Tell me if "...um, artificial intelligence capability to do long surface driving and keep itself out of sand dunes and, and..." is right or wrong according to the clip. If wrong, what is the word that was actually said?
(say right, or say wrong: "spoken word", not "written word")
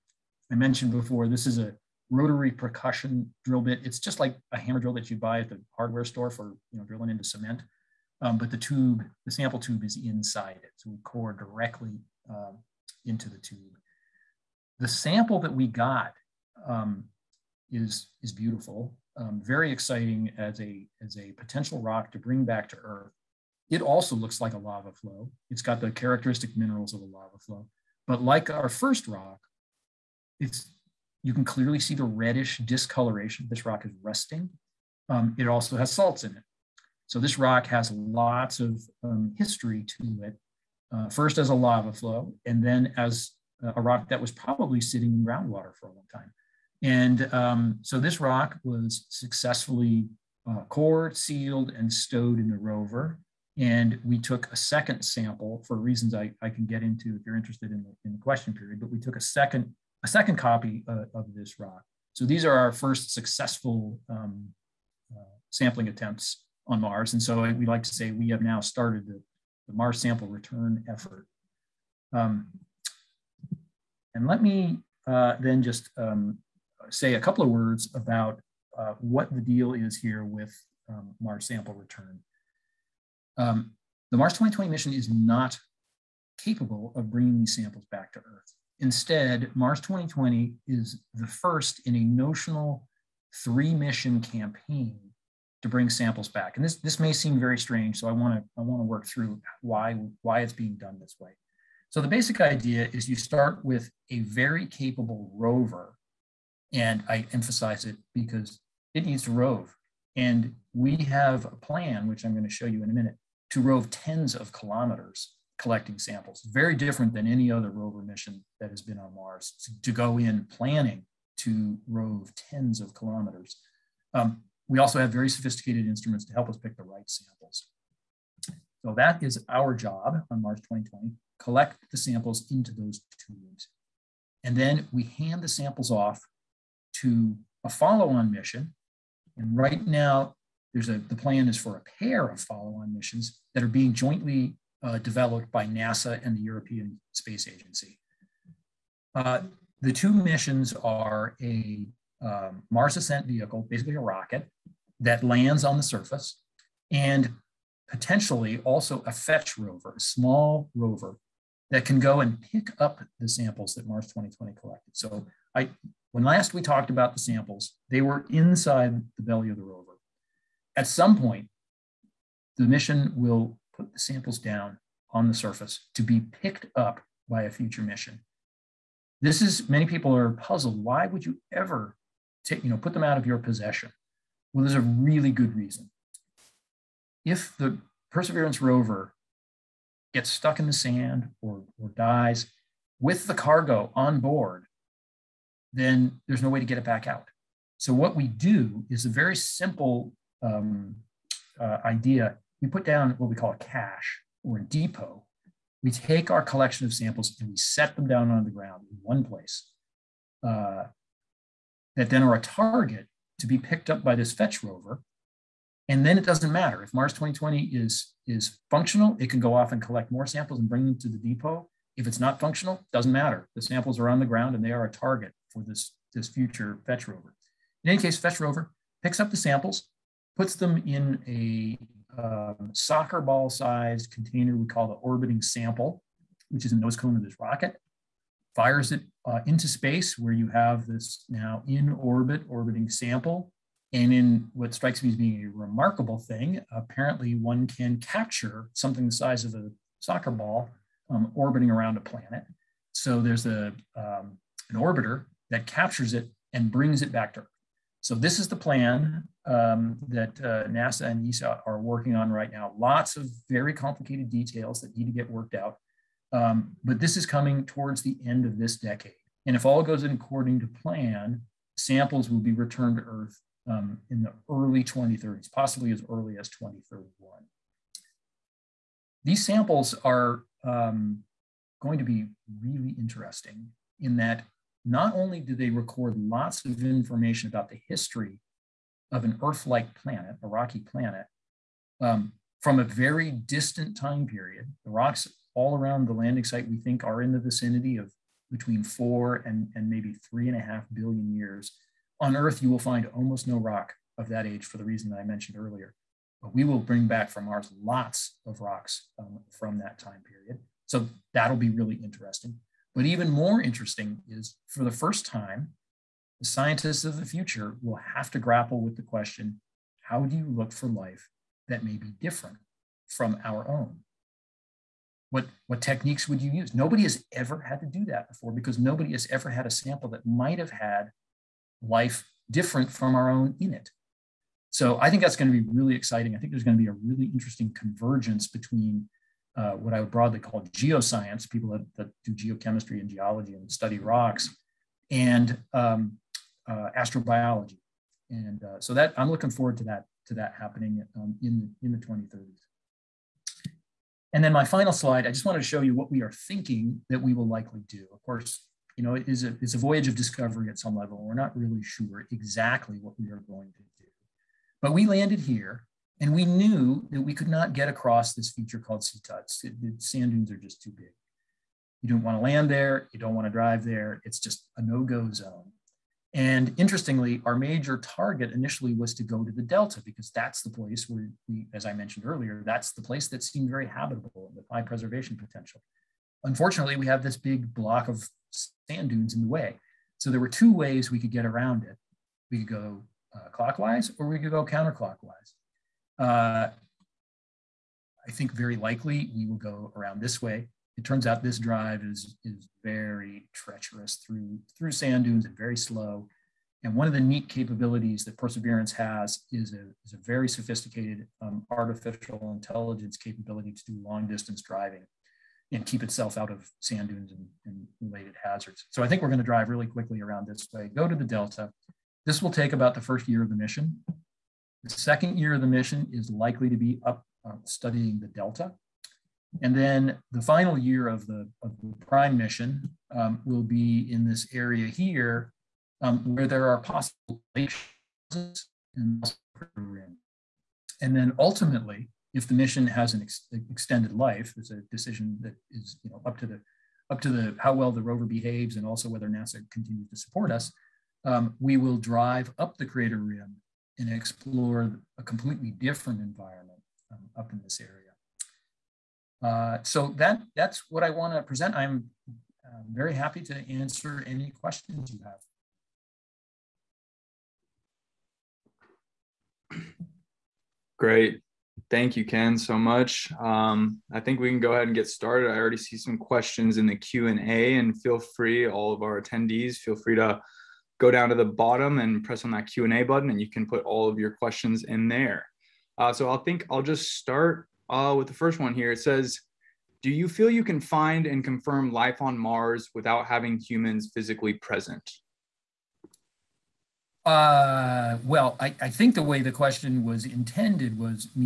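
wrong: "distance", not "surface".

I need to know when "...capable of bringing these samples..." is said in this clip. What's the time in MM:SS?
01:26.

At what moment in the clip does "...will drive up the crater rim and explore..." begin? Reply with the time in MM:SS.
07:31.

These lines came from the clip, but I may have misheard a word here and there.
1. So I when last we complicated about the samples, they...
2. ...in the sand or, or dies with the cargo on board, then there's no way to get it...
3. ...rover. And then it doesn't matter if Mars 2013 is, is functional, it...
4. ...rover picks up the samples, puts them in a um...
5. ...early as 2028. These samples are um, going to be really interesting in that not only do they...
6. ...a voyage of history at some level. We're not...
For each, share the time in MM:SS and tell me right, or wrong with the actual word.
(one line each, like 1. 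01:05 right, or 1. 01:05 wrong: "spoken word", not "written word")
1. 02:44 wrong: "talked", not "complicated"
2. 03:10 right
3. 03:34 wrong: "2020", not "2013"
4. 03:48 right
5. 04:36 wrong: "2031", not "2028"
6. 05:59 wrong: "discovery", not "history".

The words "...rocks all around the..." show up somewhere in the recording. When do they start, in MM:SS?
04:54.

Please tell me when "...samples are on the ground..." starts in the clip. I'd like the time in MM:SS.
03:43.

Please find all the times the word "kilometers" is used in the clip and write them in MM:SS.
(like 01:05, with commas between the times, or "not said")
01:54, 02:02.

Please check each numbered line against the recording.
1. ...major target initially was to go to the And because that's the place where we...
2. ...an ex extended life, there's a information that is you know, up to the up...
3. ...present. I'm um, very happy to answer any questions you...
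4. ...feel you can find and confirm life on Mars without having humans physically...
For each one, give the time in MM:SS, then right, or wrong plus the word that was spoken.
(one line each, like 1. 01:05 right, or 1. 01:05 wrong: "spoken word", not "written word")
1. 06:17 wrong: "Delta", not "And"
2. 07:23 wrong: "decision", not "information"
3. 07:41 right
4. 08:10 right.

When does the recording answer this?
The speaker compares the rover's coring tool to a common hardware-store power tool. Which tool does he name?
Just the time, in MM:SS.
00:04.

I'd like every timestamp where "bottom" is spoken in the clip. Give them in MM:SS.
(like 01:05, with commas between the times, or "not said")
08:01.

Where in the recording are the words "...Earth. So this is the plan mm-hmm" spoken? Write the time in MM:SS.
04:17.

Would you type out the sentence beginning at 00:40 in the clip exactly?
Uh, first as a lava flow, and then as uh, a rock that was probably sitting in groundwater for a long time.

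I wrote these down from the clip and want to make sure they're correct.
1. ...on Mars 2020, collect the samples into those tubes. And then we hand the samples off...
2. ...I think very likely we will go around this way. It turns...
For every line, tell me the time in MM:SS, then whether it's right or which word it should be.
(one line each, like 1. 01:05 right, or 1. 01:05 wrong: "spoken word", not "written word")
1. 02:10 right
2. 06:38 right.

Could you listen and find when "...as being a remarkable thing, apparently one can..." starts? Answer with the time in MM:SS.
04:05.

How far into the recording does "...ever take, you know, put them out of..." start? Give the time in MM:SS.
03:01.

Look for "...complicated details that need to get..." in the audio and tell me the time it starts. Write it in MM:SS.
04:23.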